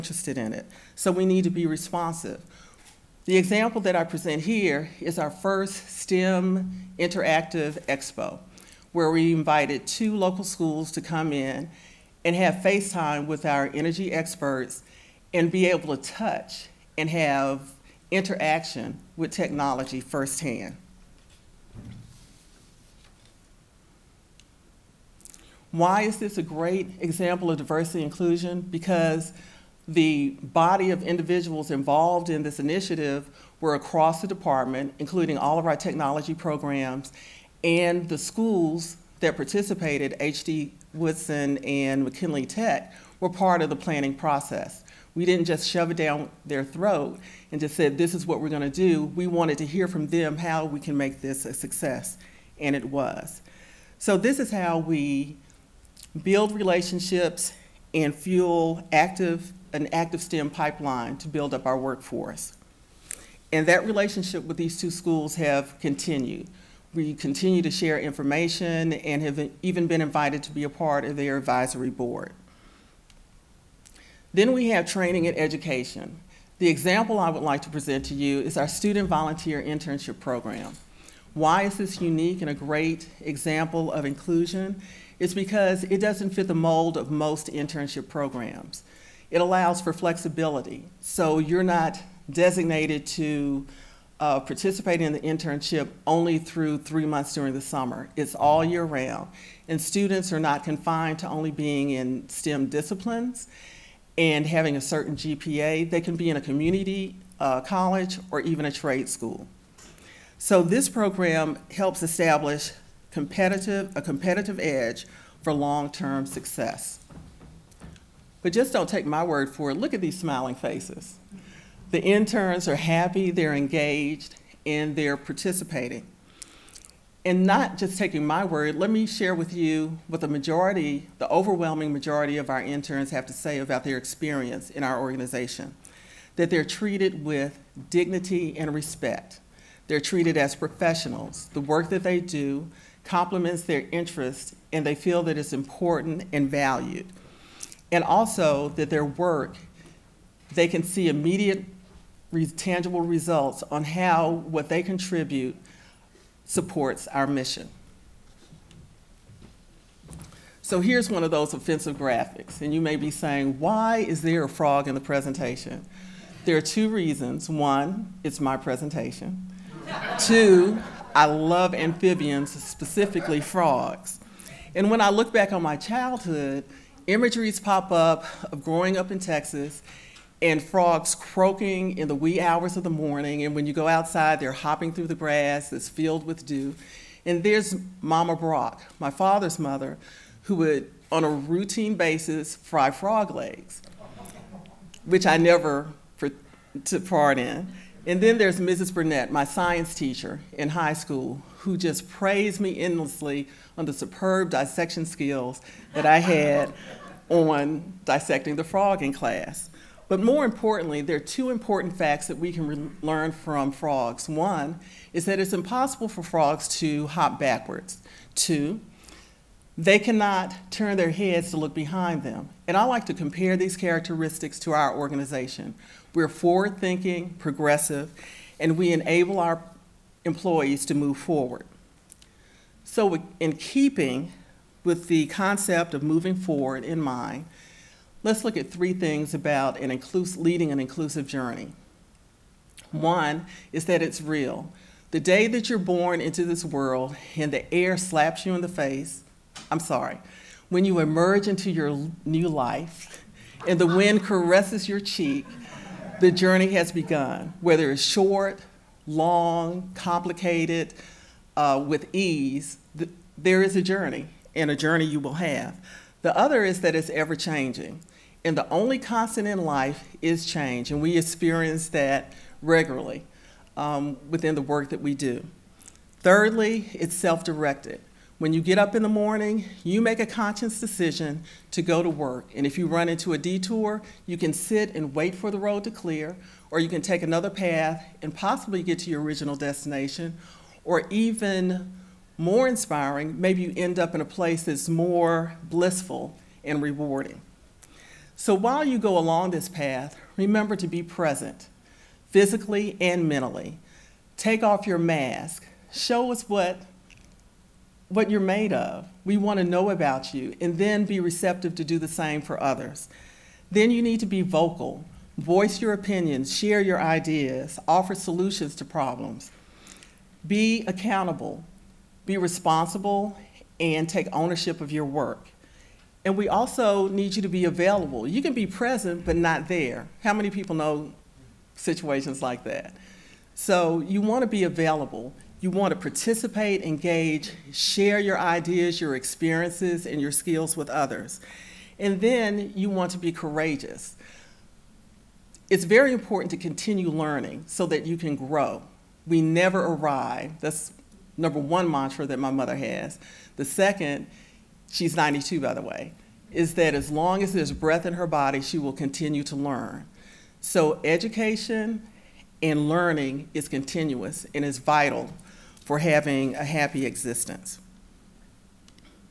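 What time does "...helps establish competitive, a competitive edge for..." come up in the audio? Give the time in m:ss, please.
1:51.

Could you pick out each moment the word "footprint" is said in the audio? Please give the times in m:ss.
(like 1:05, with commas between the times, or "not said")
not said.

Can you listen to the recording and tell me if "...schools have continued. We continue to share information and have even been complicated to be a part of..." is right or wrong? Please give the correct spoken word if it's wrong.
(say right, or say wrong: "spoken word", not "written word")
wrong: "invited", not "complicated".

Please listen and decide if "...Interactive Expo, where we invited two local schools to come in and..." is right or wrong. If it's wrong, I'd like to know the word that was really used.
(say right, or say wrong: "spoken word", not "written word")
right.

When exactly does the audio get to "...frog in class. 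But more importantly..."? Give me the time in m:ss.
3:28.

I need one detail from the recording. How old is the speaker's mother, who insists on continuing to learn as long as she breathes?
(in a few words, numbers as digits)
92.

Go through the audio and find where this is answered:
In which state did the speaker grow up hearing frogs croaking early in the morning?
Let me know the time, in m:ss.
2:59.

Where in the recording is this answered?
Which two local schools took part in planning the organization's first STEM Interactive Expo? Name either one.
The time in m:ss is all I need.
0:40.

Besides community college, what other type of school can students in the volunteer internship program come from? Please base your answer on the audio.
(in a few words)
trade school.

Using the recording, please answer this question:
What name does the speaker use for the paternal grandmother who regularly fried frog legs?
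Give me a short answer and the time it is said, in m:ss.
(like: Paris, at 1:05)
Mama Brock, at 3:08.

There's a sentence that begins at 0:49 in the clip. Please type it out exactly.
We wanted to hear from them how we can make this a success, and it was.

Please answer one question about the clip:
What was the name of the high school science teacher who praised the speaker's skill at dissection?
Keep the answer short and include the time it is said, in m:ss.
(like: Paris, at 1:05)
Mrs. Burnett, at 3:18.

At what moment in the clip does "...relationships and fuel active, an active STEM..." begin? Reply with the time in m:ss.
0:56.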